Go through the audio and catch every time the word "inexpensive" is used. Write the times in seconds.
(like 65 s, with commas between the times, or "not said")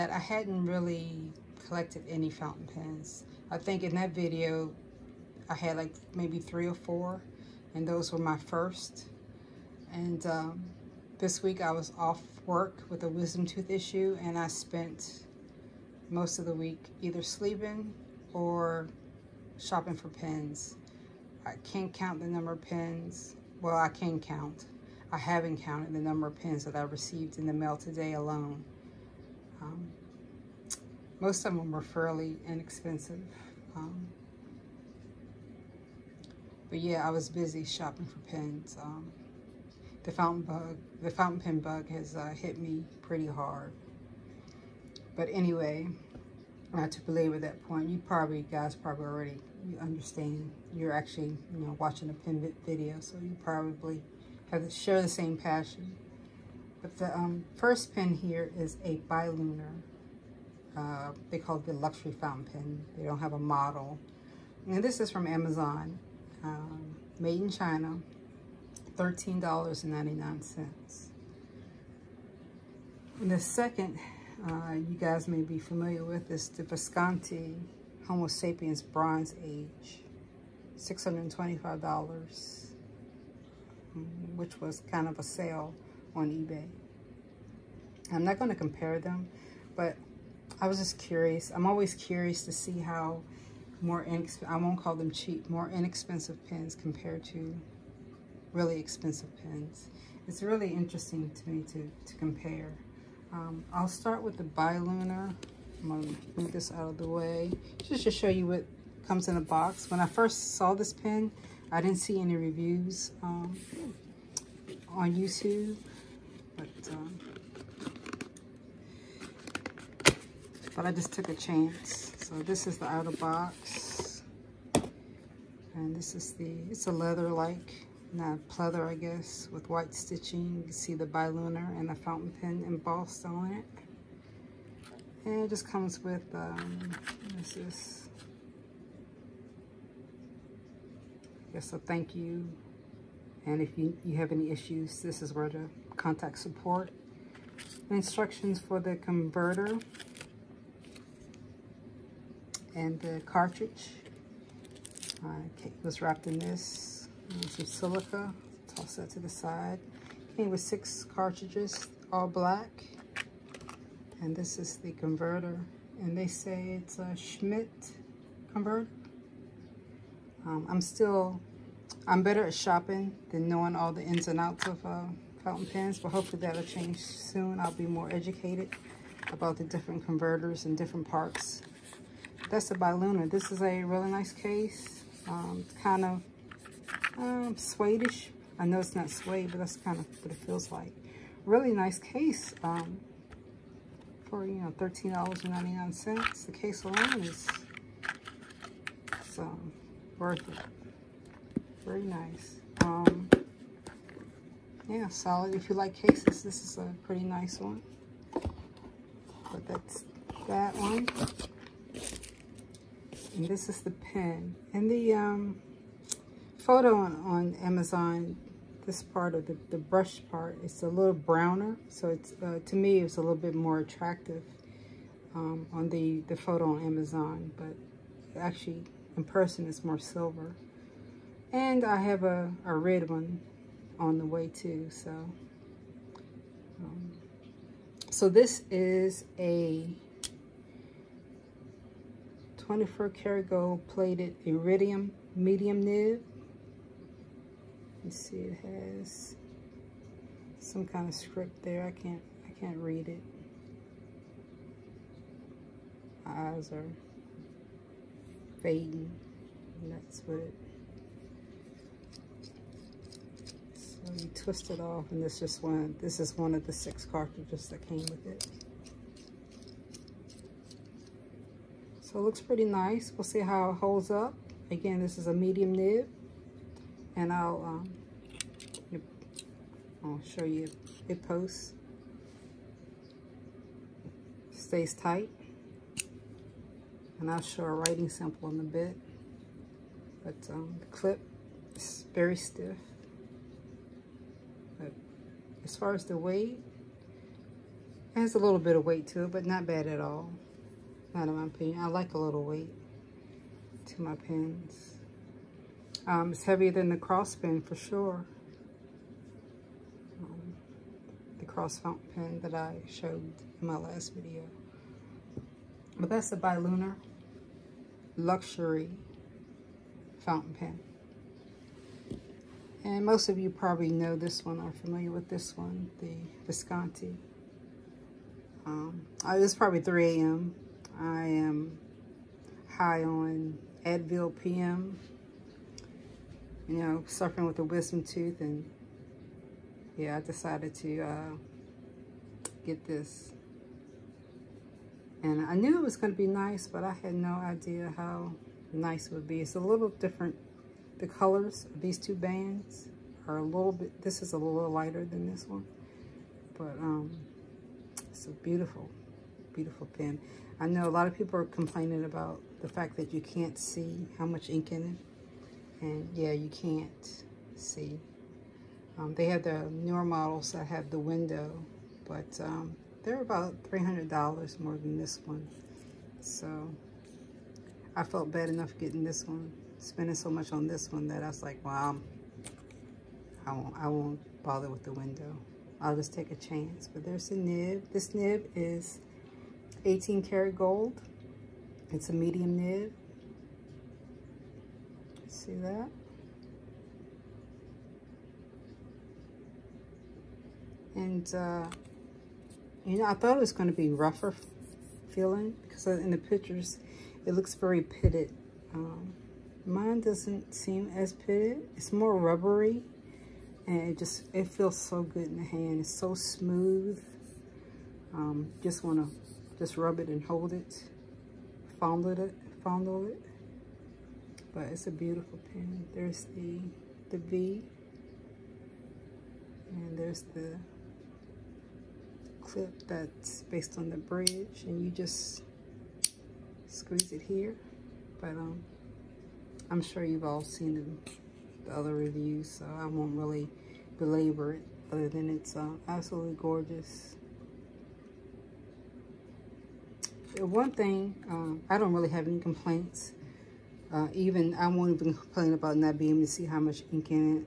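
32 s, 95 s.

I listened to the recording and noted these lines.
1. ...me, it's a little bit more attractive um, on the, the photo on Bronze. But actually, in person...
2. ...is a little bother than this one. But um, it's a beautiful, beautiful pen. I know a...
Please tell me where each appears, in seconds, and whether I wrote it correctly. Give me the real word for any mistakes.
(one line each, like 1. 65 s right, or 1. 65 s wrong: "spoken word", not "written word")
1. 222 s wrong: "Amazon", not "Bronze"
2. 354 s wrong: "lighter", not "bother".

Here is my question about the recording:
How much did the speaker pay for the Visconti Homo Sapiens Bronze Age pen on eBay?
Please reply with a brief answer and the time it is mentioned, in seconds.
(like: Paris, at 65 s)
$625, at 80 s.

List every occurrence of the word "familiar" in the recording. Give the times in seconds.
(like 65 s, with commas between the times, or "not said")
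75 s, 324 s.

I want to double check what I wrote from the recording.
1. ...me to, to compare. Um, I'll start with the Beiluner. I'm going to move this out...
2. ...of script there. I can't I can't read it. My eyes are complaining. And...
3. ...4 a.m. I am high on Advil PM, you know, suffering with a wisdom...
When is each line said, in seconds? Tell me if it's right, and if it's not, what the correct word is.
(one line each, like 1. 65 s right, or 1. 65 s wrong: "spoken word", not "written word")
1. 101 s right
2. 251 s wrong: "fading", not "complaining"
3. 329 s wrong: "3", not "4".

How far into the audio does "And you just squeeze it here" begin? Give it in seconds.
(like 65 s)
434 s.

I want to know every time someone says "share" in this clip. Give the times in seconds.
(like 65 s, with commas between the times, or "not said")
54 s.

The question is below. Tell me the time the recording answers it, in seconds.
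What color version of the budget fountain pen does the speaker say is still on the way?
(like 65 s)
232 s.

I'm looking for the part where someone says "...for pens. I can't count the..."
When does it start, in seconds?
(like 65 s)
19 s.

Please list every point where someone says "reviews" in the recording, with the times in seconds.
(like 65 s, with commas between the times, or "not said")
112 s, 441 s.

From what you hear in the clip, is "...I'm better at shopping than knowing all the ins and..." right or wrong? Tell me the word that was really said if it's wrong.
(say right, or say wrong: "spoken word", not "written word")
right.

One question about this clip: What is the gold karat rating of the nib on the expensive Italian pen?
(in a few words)
18 karat.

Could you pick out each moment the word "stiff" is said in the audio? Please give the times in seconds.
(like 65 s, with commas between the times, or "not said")
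292 s.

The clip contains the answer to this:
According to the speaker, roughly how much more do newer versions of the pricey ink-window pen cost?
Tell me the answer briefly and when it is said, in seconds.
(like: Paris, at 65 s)
$300, at 373 s.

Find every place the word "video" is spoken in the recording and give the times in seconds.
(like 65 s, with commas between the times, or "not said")
4 s, 52 s, 314 s.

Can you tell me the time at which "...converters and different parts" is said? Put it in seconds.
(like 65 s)
180 s.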